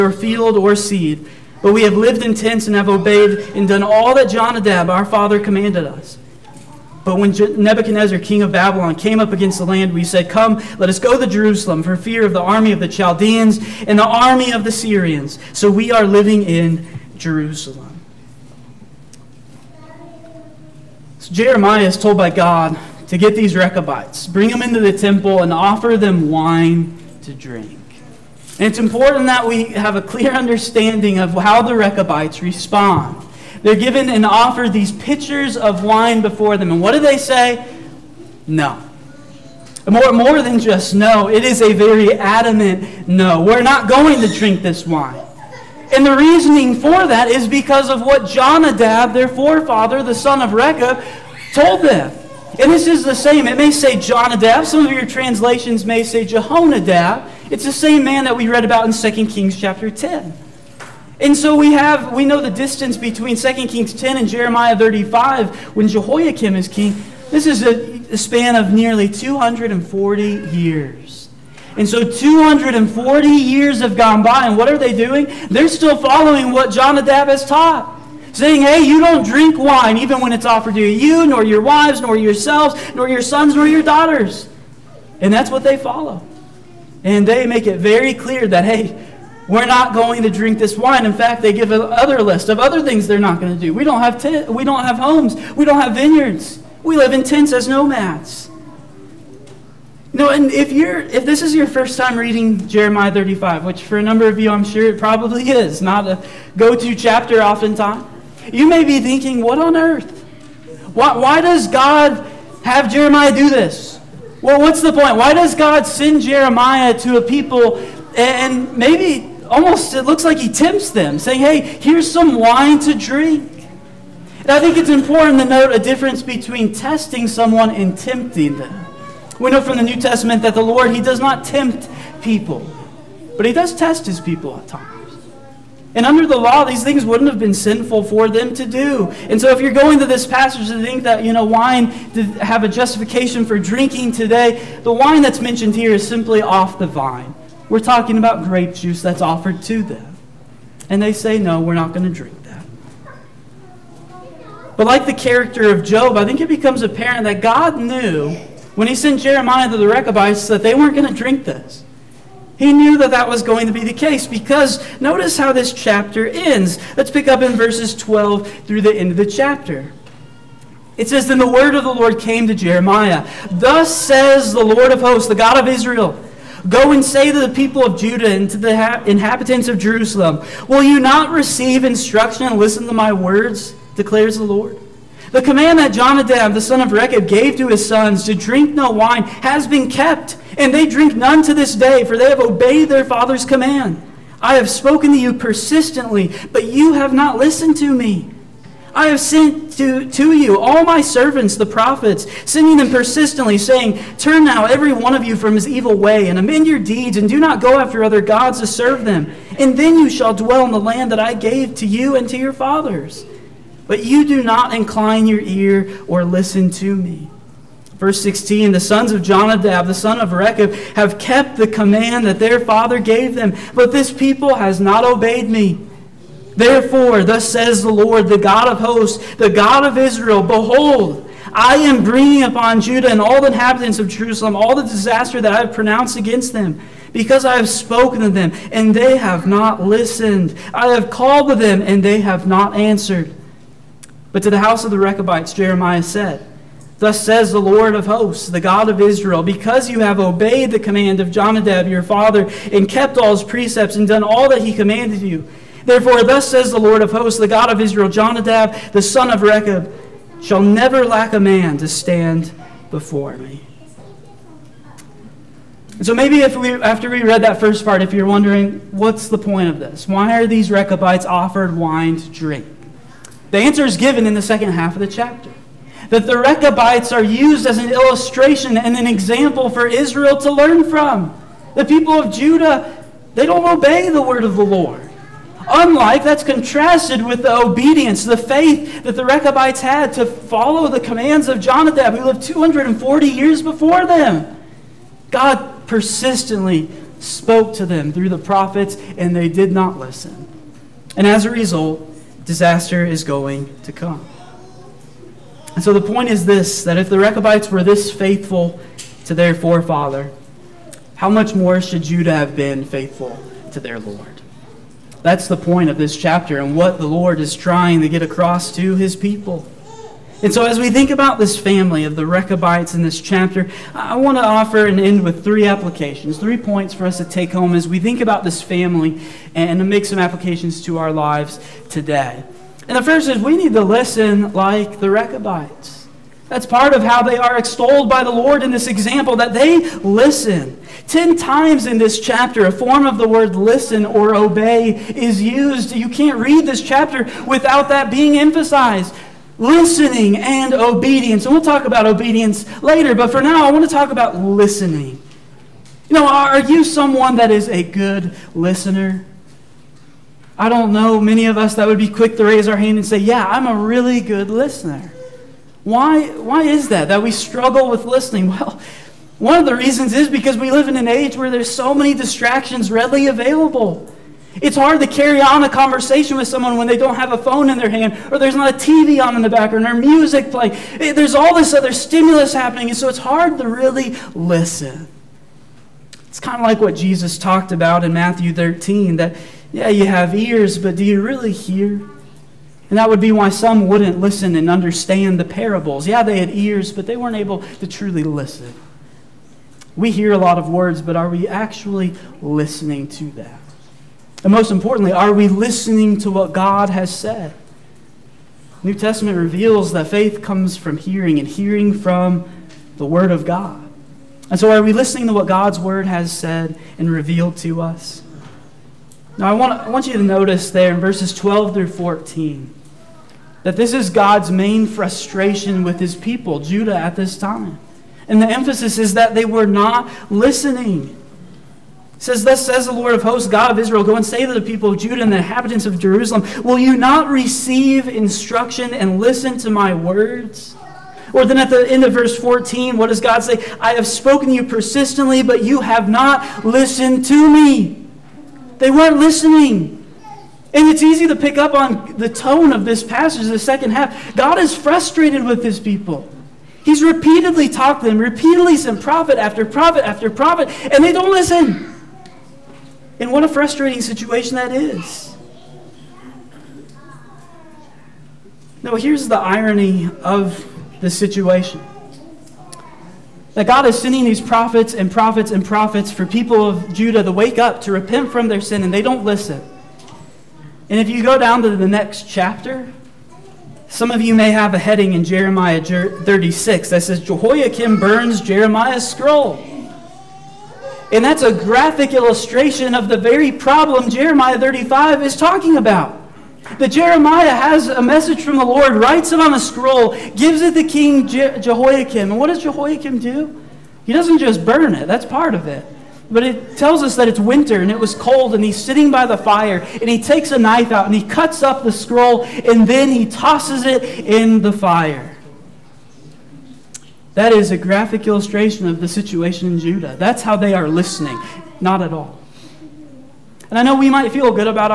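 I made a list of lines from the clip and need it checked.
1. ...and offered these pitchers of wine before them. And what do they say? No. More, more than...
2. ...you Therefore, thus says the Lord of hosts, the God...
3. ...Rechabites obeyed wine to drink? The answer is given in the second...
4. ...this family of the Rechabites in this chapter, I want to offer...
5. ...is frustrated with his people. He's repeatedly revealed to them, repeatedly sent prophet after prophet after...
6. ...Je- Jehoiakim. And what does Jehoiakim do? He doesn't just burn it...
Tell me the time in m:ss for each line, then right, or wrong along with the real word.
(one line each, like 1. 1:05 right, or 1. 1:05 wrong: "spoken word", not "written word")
1. 0:34 right
2. 4:15 right
3. 4:30 wrong: "offered", not "obeyed"
4. 5:21 right
5. 7:34 wrong: "talked", not "revealed"
6. 8:21 right.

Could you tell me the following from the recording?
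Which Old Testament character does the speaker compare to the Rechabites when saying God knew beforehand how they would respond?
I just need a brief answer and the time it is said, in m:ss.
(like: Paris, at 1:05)
Job, at 2:35.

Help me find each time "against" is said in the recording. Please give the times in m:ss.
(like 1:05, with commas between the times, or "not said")
0:09, 3:56.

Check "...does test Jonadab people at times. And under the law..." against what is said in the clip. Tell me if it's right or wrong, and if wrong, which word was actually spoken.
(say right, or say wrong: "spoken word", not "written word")
wrong: "His", not "Jonadab".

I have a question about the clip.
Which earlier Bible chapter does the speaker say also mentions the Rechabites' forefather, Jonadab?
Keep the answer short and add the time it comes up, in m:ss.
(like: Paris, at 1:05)
2 Kings chapter 10, at 0:58.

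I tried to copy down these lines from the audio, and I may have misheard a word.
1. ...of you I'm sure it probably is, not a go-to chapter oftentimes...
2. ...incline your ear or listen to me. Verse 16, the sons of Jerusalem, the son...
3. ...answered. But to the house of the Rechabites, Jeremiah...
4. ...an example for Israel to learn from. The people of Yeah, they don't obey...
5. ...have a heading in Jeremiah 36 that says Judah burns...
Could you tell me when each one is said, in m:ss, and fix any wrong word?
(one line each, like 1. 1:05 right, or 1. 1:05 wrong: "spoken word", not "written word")
1. 1:44 right
2. 3:34 wrong: "Jonadab", not "Jerusalem"
3. 4:02 right
4. 4:38 wrong: "Judah", not "Yeah"
5. 8:04 wrong: "Jehoiakim", not "Judah".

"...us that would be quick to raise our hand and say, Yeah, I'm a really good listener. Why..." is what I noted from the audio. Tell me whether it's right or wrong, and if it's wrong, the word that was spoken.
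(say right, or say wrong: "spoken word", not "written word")
right.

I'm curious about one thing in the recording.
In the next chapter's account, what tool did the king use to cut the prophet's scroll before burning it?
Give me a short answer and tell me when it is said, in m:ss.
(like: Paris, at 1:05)
a knife, at 8:30.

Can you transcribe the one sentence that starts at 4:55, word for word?
God persistently spoke to them through the prophets, and they did not listen.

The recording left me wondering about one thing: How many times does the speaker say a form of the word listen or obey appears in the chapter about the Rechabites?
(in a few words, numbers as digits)
10.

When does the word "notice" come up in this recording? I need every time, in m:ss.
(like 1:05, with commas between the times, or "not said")
2:44, 7:00.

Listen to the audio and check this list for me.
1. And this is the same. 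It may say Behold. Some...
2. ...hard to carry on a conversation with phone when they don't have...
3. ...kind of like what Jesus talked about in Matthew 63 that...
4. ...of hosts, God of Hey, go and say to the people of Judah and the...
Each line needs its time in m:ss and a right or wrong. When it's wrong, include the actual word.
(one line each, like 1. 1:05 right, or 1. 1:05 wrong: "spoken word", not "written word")
1. 0:52 wrong: "Jonadab", not "Behold"
2. 6:14 wrong: "someone", not "phone"
3. 6:26 wrong: "13", not "63"
4. 7:13 wrong: "Israel", not "Hey".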